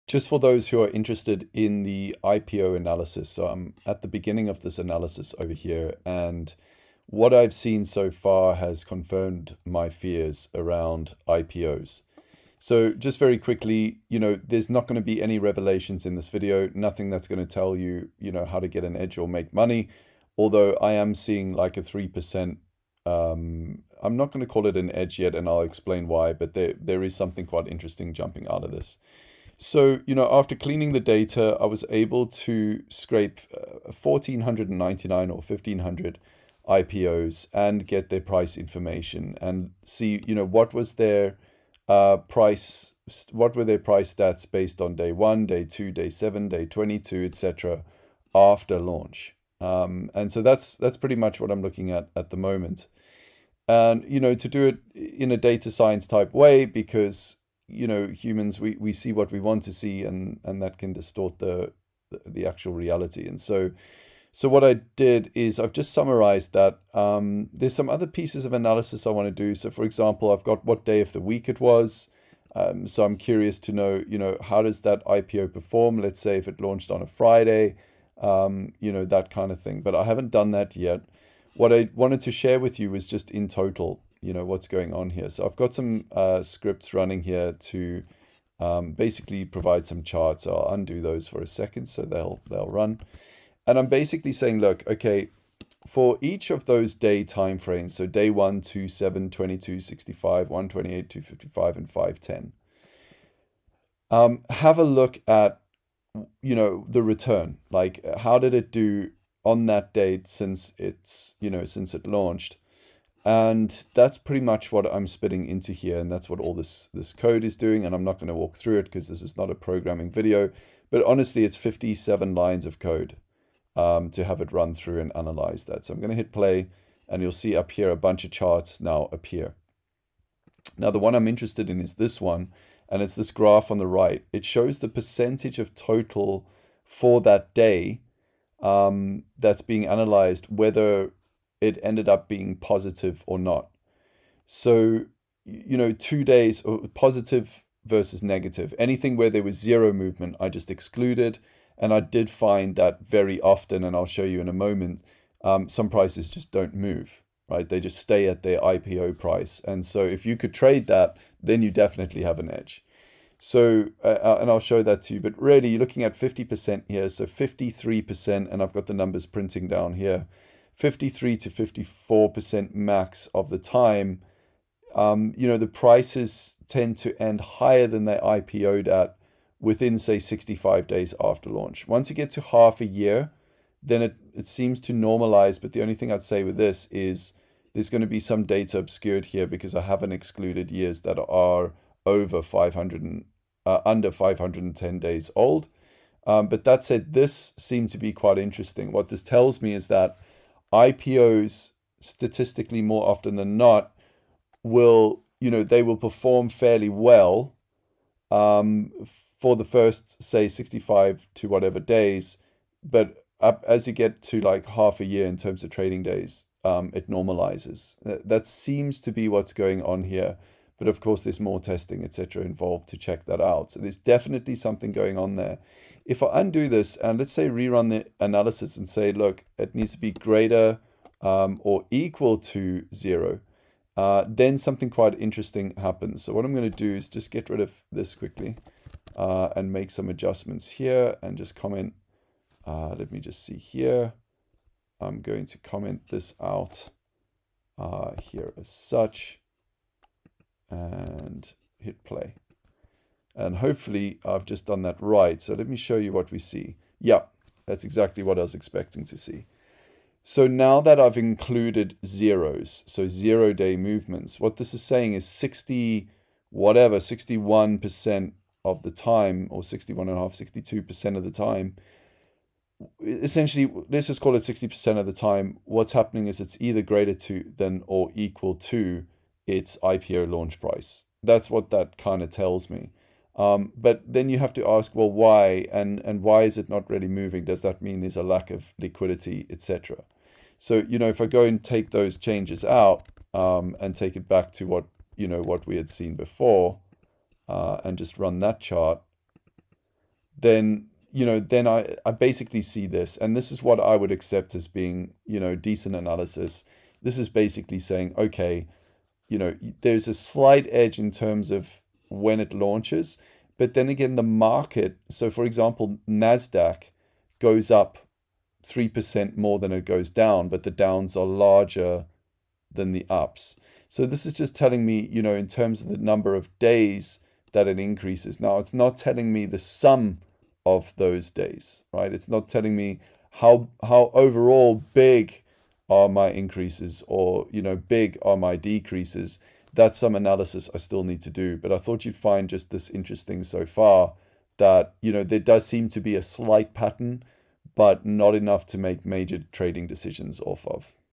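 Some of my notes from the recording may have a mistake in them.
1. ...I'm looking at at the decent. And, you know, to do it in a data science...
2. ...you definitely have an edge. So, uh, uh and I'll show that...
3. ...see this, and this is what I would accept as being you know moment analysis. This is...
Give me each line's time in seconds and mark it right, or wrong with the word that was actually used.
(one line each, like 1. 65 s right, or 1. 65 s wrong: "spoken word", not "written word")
1. 51 s wrong: "moment", not "decent"
2. 161 s right
3. 302 s wrong: "decent", not "moment".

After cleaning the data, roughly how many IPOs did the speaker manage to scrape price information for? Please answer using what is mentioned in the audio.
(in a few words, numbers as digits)
1,499.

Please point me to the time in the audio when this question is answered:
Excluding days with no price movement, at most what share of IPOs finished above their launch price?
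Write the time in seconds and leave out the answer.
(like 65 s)
170 s.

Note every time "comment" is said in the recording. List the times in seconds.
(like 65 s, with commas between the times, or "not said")
241 s, 245 s.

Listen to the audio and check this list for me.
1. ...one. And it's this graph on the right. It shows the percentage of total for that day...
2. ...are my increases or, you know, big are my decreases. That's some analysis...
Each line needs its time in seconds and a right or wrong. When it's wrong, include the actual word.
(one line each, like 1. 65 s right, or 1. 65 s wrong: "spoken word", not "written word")
1. 132 s right
2. 335 s right.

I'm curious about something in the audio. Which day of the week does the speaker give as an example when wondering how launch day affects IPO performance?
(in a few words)
Friday.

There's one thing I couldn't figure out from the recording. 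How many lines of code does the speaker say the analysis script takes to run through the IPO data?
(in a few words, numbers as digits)
57.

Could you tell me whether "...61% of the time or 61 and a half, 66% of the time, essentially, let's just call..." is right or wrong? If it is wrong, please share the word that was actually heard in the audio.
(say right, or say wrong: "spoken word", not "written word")
wrong: "62", not "66".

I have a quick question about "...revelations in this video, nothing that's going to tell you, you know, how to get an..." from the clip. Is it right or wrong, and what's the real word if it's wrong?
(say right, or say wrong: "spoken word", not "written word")
right.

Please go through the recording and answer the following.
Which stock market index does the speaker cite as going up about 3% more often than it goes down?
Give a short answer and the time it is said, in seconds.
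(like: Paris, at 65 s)
NASDAQ, at 316 s.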